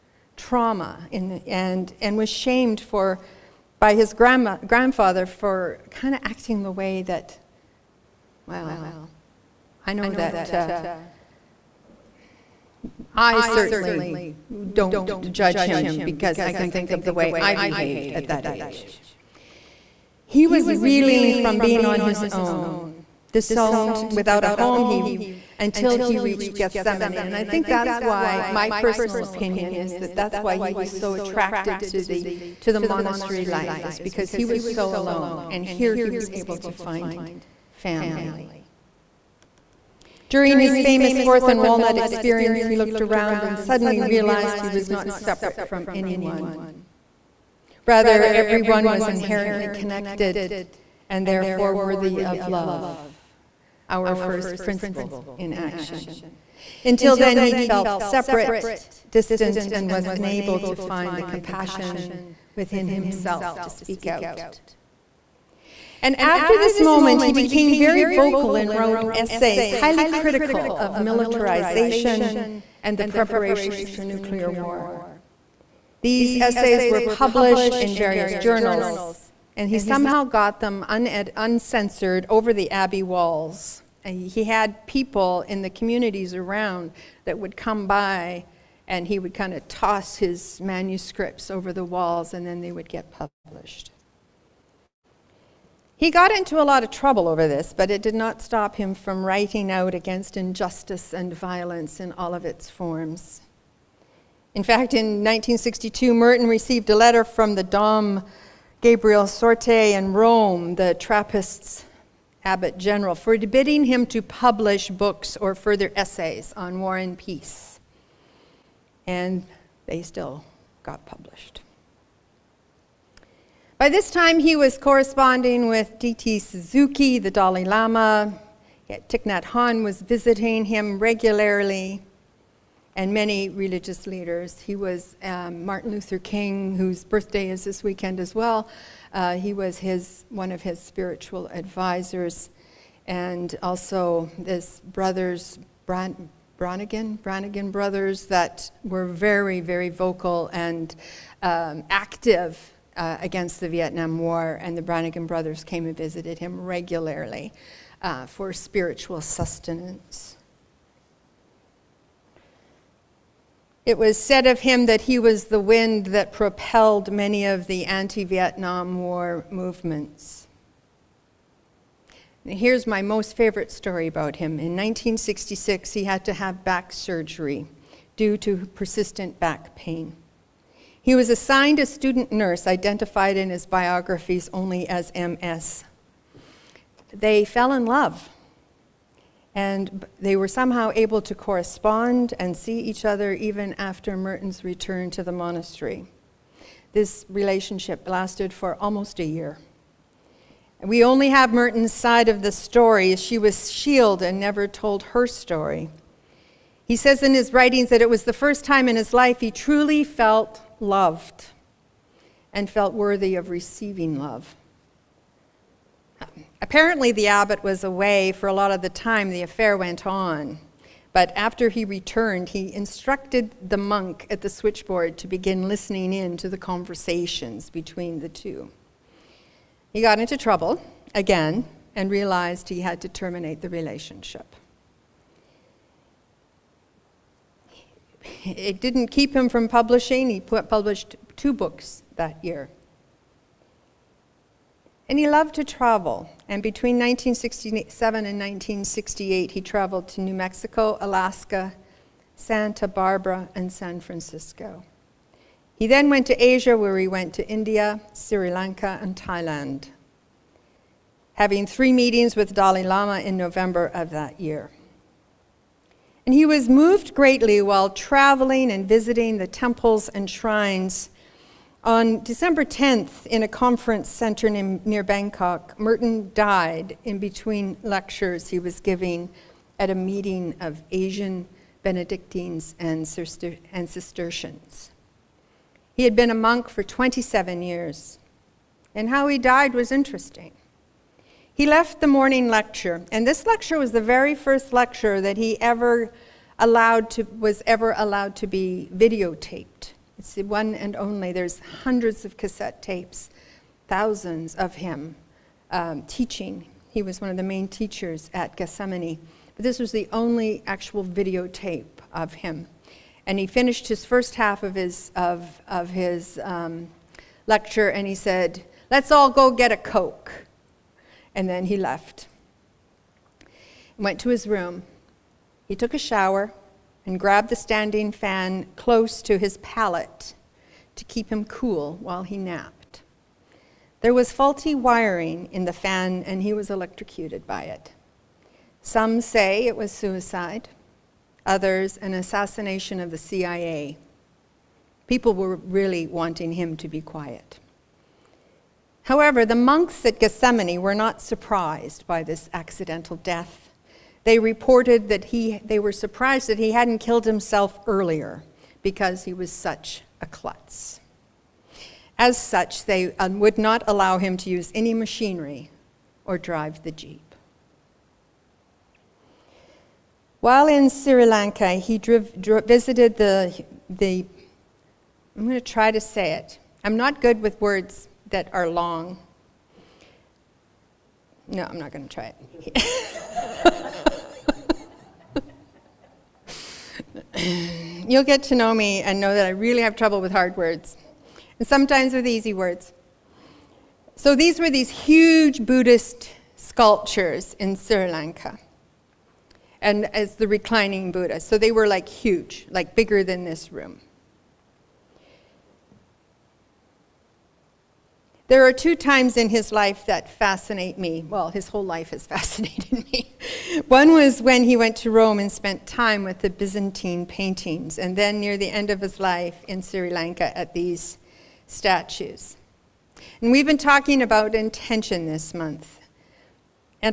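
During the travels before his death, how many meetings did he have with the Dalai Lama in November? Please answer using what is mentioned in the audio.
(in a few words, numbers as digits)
3.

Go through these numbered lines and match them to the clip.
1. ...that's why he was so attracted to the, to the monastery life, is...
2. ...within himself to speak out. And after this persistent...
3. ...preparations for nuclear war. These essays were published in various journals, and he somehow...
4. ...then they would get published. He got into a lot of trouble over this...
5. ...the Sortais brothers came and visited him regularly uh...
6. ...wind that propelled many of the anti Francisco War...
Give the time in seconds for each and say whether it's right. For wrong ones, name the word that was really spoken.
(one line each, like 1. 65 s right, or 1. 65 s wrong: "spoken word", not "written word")
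1. 30 s right
2. 62 s wrong: "moment", not "persistent"
3. 73 s right
4. 92 s right
5. 154 s wrong: "Brannigan", not "Sortais"
6. 165 s wrong: "Vietnam", not "Francisco".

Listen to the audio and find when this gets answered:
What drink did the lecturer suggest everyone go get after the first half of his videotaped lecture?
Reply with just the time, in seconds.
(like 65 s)
319 s.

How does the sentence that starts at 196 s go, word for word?
This relationship lasted for almost a year.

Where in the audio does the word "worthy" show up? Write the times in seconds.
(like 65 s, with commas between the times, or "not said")
51 s, 212 s.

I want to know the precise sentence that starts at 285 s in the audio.
He had been a monk for 27 years, and how he died was interesting.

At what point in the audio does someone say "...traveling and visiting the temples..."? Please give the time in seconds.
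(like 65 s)
267 s.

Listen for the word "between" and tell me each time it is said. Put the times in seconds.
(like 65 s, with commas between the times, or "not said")
227 s, 246 s, 277 s.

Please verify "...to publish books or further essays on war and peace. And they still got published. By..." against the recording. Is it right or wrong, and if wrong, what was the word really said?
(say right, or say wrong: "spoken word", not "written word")
right.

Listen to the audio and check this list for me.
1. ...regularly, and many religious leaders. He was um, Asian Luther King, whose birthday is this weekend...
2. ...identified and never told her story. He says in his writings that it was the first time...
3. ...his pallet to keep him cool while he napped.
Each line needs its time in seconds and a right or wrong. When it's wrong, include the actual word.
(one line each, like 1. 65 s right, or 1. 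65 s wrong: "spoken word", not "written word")
1. 130 s wrong: "Martin", not "Asian"
2. 203 s wrong: "shielded", not "identified"
3. 329 s right.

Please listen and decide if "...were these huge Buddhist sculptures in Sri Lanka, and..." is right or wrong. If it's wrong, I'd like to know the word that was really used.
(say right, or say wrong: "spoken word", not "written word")
right.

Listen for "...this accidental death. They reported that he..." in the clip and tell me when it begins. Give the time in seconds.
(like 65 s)
352 s.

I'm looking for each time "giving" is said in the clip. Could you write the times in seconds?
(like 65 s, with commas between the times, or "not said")
278 s.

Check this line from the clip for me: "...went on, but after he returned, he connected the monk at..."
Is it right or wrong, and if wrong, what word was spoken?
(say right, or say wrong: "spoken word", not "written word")
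wrong: "instructed", not "connected".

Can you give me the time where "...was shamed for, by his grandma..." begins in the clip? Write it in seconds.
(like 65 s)
2 s.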